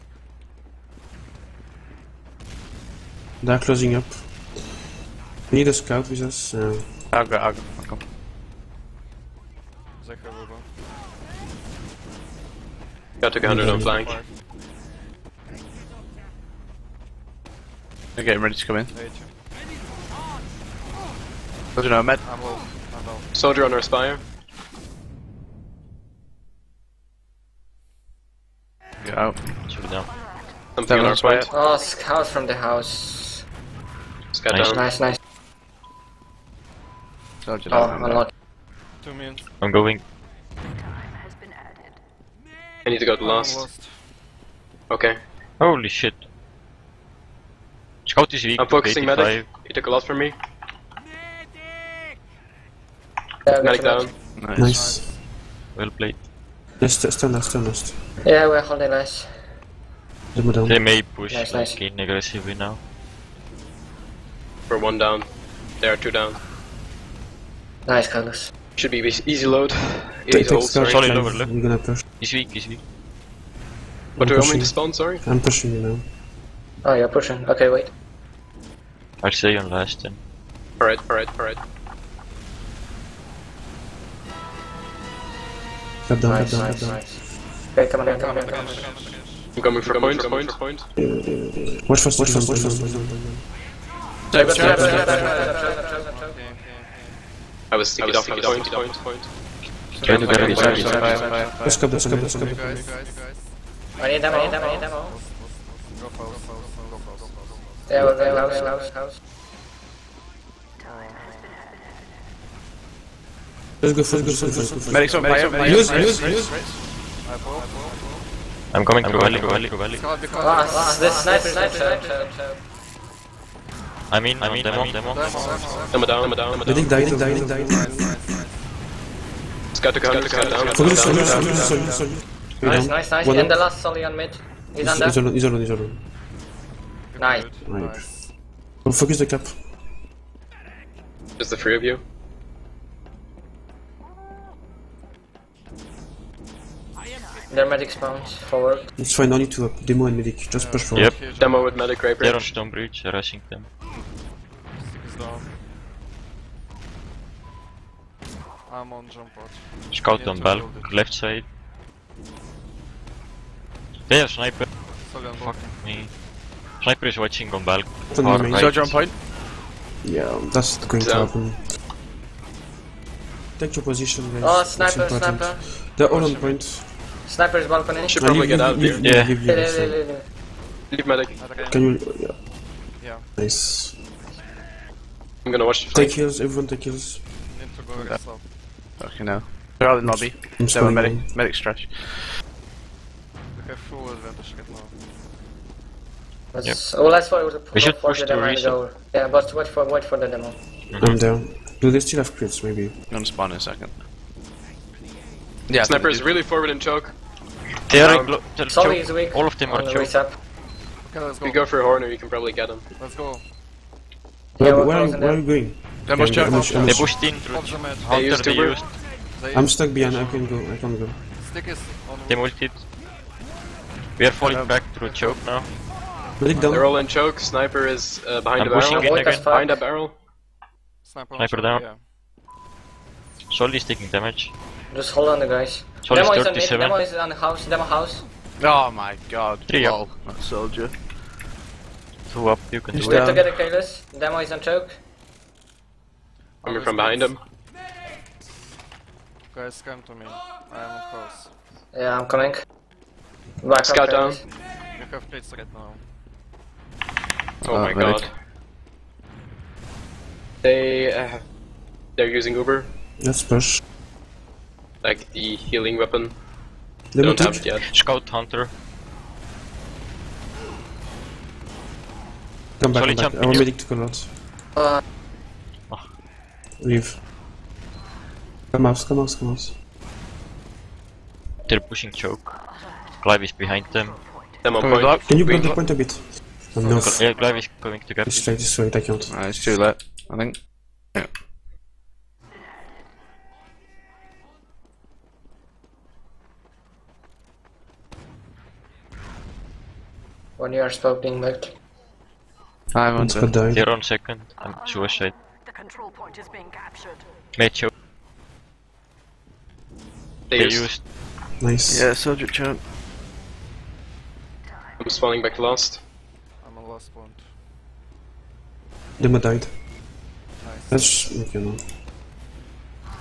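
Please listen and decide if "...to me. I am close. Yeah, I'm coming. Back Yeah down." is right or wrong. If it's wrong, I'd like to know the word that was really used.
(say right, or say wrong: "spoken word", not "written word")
wrong: "Scout", not "Yeah".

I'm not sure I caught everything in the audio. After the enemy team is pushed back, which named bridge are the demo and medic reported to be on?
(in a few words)
Stone bridge.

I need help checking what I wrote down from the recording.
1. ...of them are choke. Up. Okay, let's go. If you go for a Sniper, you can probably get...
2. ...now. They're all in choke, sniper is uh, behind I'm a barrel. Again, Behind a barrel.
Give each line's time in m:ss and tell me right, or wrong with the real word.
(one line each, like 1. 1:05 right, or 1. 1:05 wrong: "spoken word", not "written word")
1. 3:29 wrong: "Horner", not "Sniper"
2. 3:45 right.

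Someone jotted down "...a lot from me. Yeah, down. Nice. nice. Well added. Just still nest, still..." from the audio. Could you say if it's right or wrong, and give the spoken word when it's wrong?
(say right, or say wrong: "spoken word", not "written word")
wrong: "played", not "added".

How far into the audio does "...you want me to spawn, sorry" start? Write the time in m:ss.
1:14.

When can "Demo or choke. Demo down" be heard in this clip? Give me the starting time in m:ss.
2:05.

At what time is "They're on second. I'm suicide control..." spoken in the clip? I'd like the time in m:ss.
5:03.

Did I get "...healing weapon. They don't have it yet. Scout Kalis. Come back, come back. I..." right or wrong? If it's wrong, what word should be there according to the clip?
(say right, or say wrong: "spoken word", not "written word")
wrong: "Hunter", not "Kalis".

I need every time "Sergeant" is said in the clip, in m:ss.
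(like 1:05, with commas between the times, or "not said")
5:12.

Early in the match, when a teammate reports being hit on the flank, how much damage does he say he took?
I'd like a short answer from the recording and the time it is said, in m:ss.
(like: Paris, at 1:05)
100, at 0:13.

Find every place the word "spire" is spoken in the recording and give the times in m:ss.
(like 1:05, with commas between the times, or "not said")
0:23, 0:31.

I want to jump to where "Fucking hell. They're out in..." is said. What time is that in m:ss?
3:08.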